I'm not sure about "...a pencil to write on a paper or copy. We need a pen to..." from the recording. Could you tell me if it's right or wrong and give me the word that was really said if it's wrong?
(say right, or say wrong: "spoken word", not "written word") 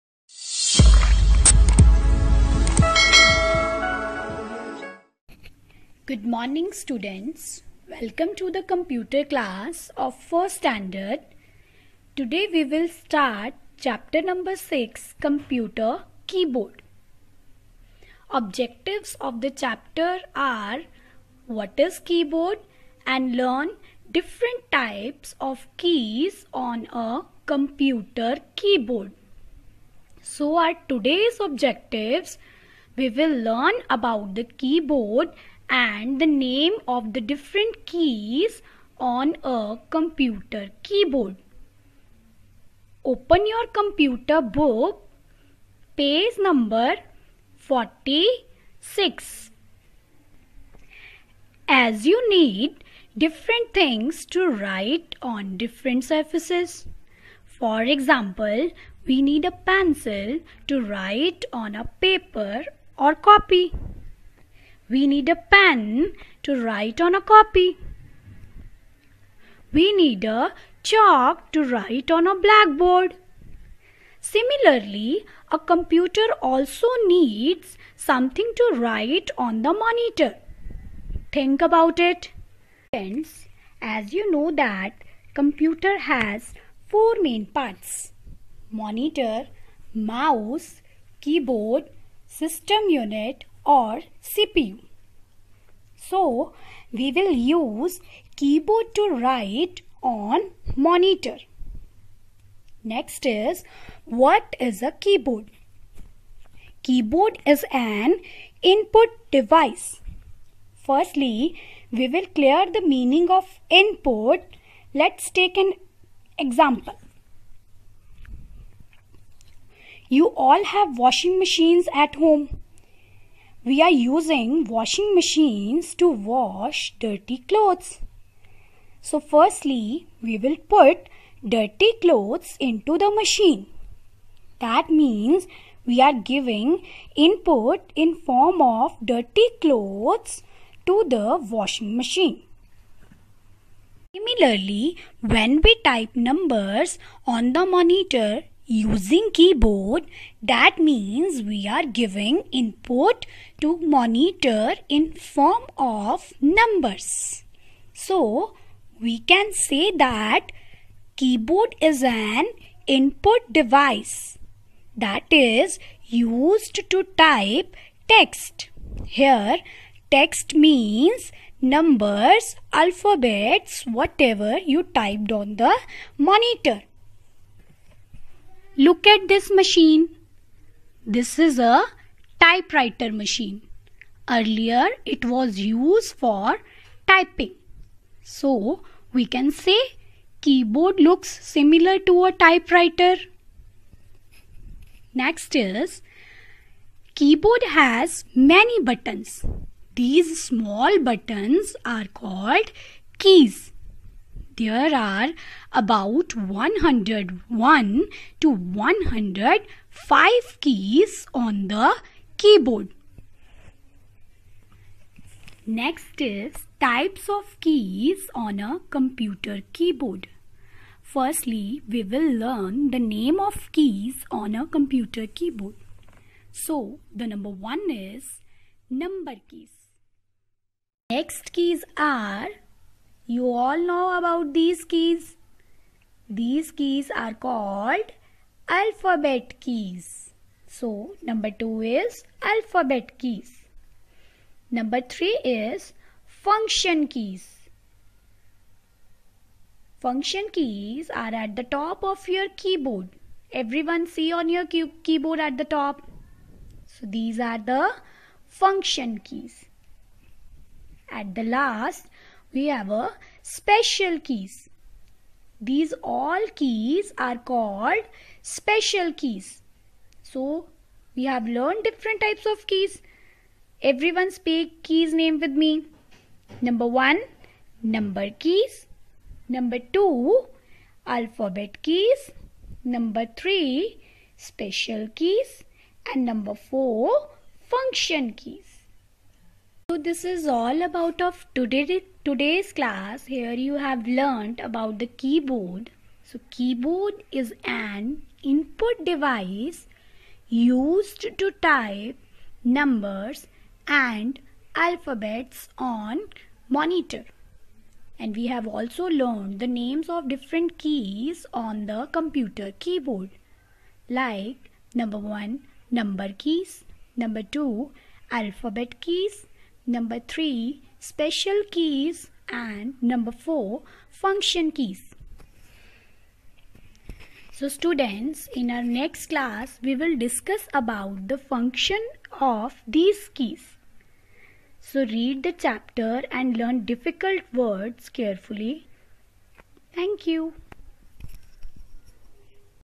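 right.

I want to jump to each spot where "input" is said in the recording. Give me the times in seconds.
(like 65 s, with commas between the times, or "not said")
108 s, 113 s, 137 s, 152 s, 162 s, 298 s.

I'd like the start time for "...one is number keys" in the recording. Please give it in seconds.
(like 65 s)
227 s.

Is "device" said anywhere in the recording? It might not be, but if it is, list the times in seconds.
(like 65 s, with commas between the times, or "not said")
109 s, 163 s, 299 s.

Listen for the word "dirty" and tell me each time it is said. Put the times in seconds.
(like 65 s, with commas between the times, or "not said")
126 s, 131 s, 139 s.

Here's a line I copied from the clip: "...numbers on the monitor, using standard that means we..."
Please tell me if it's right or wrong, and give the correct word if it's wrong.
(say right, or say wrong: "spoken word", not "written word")
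wrong: "keyboard", not "standard".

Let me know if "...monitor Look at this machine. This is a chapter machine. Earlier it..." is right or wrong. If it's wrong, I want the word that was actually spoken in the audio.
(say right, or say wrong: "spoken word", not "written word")
wrong: "typewriter", not "chapter".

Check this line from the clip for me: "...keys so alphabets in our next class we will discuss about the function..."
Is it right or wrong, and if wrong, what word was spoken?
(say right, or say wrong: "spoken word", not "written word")
wrong: "students", not "alphabets".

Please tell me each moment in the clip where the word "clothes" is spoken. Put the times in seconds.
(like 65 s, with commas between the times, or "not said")
127 s, 132 s, 139 s.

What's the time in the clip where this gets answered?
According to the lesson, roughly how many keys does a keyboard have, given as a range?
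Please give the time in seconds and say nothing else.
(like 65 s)
206 s.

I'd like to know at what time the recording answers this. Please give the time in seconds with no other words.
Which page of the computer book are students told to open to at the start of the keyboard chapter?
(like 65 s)
45 s.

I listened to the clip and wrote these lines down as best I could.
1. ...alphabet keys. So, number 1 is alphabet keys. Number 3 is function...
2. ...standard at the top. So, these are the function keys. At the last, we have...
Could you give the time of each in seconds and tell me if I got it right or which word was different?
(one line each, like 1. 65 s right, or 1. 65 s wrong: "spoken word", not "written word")
1. 238 s wrong: "2", not "1"
2. 254 s wrong: "keyboard", not "standard".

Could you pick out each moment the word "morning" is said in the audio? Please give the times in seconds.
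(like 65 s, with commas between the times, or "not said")
6 s.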